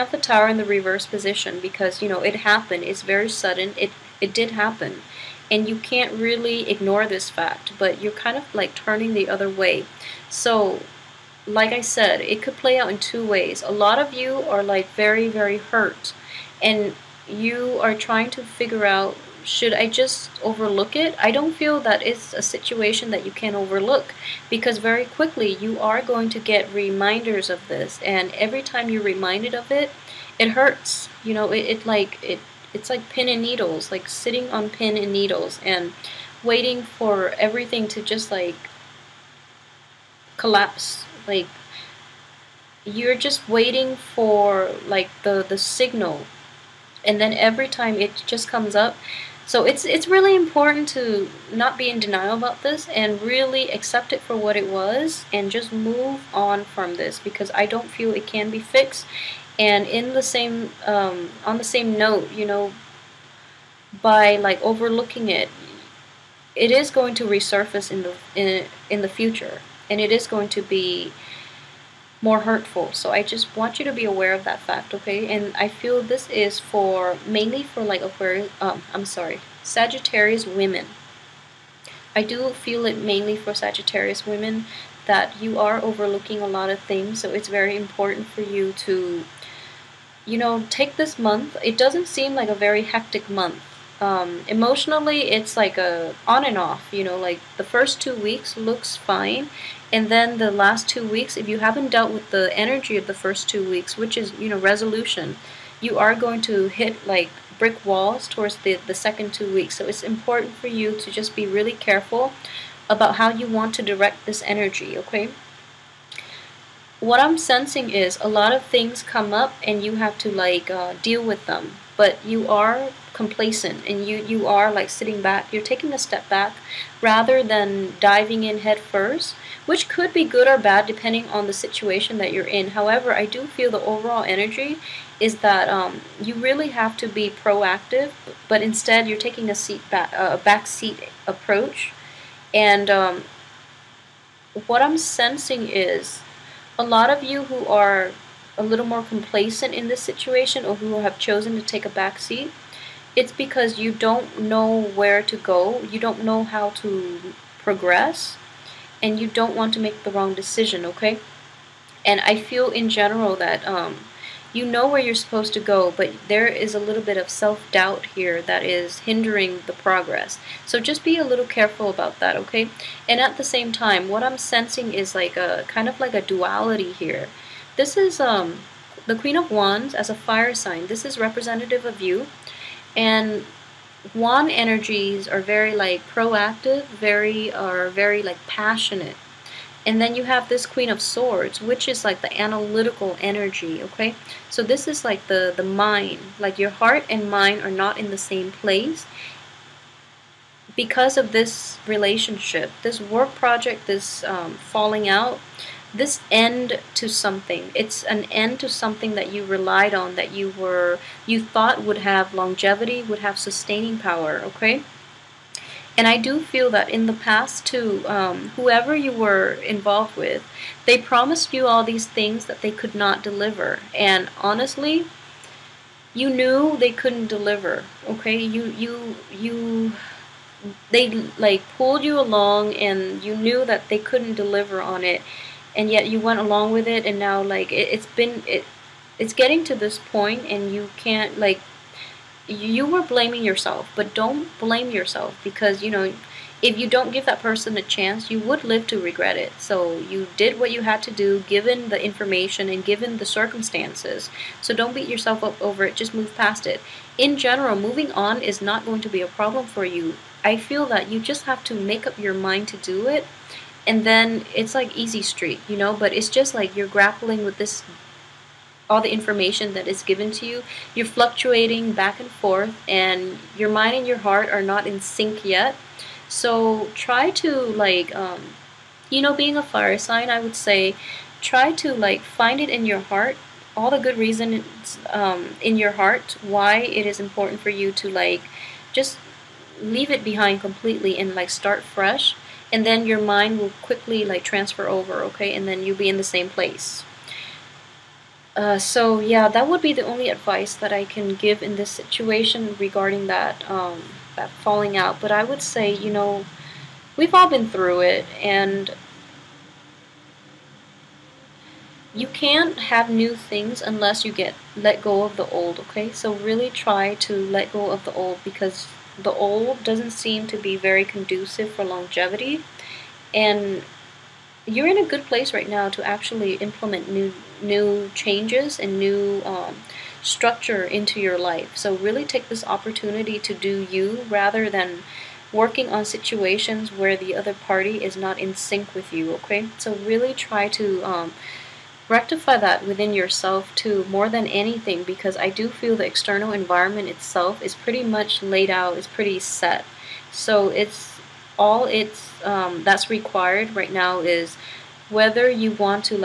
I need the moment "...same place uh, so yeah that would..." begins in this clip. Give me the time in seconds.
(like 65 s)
296 s.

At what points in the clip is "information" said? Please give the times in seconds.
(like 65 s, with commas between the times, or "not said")
252 s, 269 s.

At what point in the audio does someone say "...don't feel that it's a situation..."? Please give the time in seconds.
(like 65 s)
21 s.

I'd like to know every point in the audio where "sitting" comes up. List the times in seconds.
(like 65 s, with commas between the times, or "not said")
34 s, 124 s.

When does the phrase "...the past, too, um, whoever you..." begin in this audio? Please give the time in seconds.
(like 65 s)
217 s.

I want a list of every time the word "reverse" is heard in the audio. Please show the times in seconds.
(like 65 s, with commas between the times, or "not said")
0 s.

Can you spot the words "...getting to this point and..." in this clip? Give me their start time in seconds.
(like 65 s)
239 s.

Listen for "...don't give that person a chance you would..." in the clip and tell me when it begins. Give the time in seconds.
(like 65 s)
246 s.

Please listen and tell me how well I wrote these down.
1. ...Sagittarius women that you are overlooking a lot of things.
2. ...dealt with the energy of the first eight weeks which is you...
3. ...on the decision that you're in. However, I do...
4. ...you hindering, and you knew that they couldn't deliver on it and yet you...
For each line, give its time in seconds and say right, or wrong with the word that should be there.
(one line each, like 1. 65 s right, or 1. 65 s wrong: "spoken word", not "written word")
1. 83 s right
2. 101 s wrong: "two", not "eight"
3. 131 s wrong: "situation", not "decision"
4. 232 s wrong: "along", not "hindering".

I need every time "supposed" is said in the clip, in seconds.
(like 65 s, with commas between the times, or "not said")
165 s.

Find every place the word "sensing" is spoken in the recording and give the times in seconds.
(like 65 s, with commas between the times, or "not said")
117 s, 144 s, 174 s.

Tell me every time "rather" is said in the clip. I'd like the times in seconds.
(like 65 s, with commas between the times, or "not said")
127 s, 334 s.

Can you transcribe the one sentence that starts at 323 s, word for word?
And you're in a good place right now to actually implement new new changes and new um, structure into your life.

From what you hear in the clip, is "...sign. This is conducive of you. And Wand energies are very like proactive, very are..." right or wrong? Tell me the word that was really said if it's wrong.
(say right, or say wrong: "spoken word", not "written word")
wrong: "representative", not "conducive".